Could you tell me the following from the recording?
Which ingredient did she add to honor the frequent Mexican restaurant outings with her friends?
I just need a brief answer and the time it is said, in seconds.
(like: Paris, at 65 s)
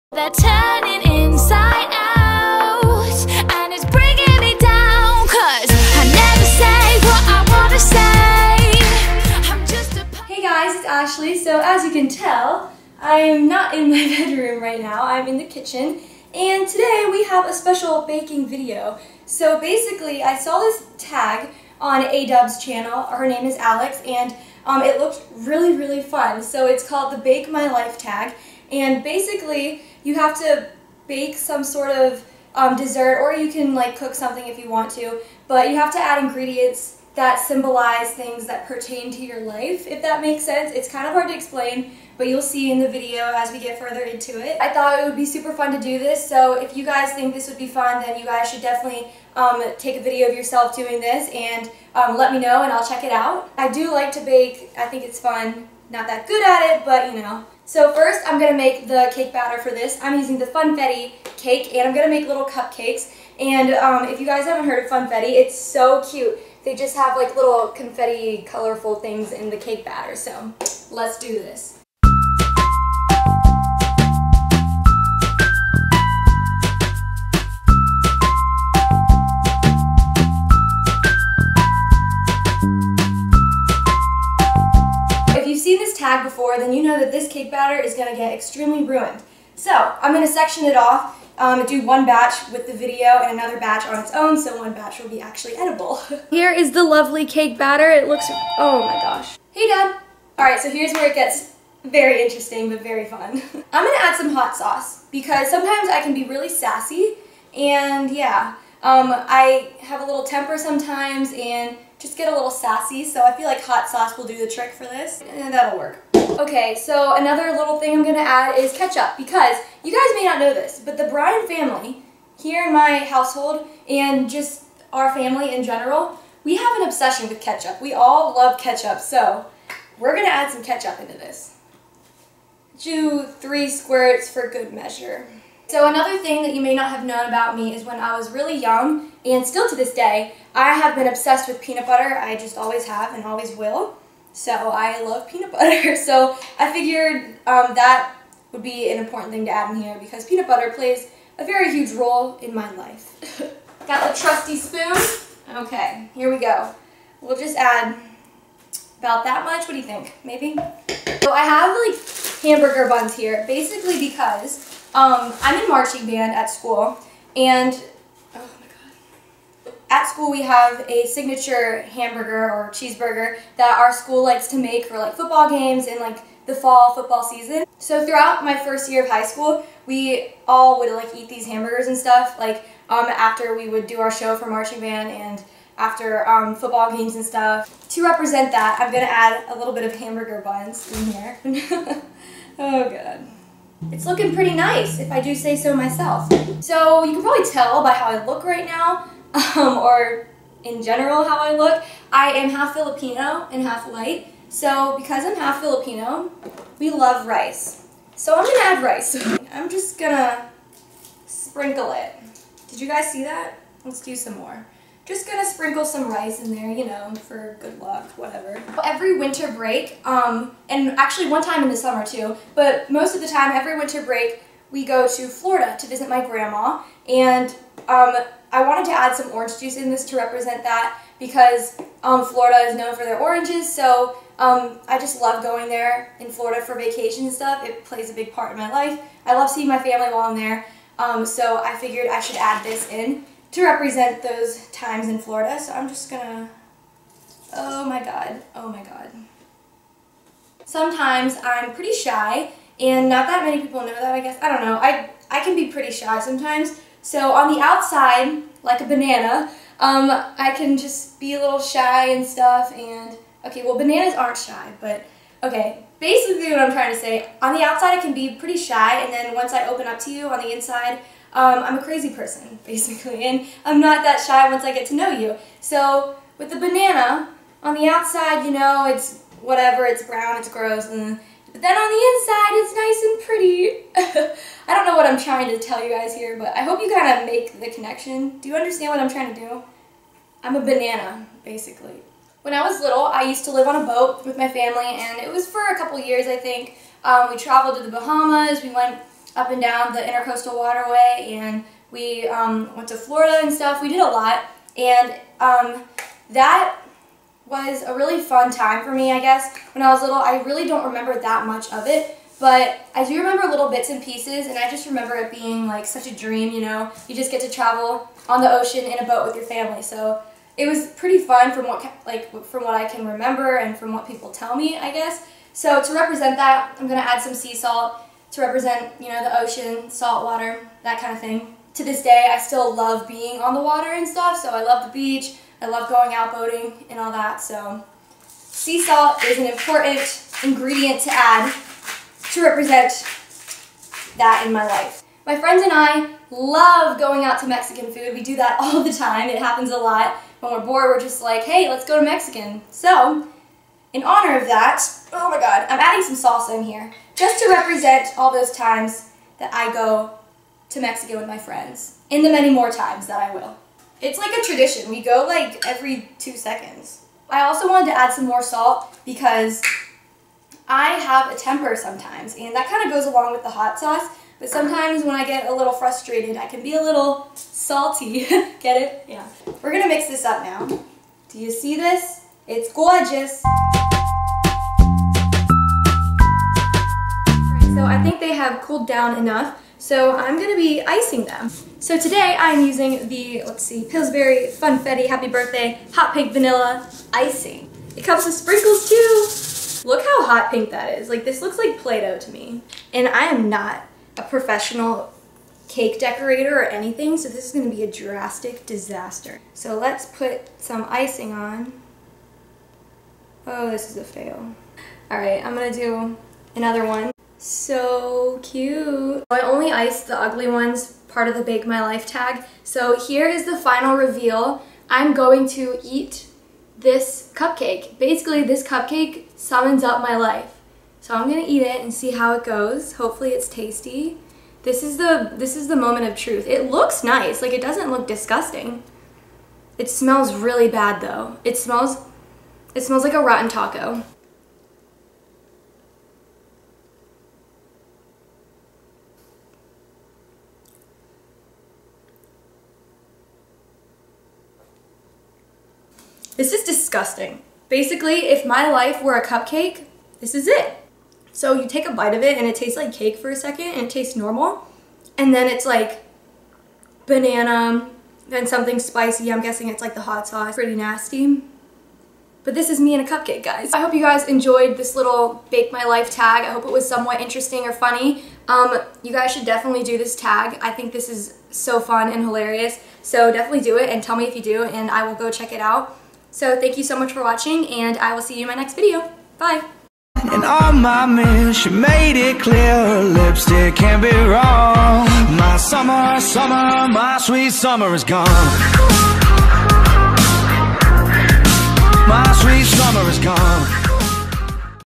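Salsa, at 356 s.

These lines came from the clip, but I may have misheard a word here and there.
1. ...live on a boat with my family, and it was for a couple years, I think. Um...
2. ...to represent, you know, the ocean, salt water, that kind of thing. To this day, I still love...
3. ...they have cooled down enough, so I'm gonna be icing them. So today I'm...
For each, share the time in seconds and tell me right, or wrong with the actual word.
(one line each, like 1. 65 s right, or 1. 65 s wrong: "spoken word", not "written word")
1. 293 s right
2. 328 s right
3. 388 s right.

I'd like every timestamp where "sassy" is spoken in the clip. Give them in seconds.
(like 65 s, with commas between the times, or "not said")
106 s, 112 s.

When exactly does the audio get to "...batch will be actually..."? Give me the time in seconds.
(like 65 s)
94 s.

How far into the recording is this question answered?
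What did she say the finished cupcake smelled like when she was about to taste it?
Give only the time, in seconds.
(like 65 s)
443 s.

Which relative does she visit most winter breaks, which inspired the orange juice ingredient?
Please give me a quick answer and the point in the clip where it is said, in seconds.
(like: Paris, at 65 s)
Grandma, at 226 s.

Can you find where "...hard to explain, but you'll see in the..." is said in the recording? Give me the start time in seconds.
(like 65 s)
41 s.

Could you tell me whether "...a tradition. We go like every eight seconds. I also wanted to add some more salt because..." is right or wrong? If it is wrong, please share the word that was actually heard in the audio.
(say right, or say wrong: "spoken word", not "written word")
wrong: "two", not "eight".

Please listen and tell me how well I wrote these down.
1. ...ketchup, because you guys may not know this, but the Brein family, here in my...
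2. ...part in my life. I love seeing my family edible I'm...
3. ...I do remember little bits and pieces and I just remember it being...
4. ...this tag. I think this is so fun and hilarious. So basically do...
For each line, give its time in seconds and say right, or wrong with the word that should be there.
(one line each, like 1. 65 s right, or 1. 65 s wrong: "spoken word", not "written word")
1. 118 s right
2. 238 s wrong: "while", not "edible"
3. 312 s right
4. 479 s wrong: "definitely", not "basically".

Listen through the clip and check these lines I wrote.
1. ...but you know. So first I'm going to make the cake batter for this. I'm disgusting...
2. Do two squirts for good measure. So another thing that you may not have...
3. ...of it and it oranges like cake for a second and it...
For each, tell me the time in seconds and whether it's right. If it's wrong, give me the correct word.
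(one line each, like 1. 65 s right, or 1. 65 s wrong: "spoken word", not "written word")
1. 56 s wrong: "using", not "disgusting"
2. 132 s wrong: "three", not "two"
3. 462 s wrong: "tastes", not "oranges".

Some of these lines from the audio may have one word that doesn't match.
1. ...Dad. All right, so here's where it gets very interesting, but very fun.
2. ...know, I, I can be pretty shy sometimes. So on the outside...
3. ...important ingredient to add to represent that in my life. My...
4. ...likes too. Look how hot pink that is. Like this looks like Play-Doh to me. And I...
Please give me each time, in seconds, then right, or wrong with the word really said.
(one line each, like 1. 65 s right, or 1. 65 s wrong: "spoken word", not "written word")
1. 99 s right
2. 254 s right
3. 339 s right
4. 398 s wrong: "sprinkles", not "likes".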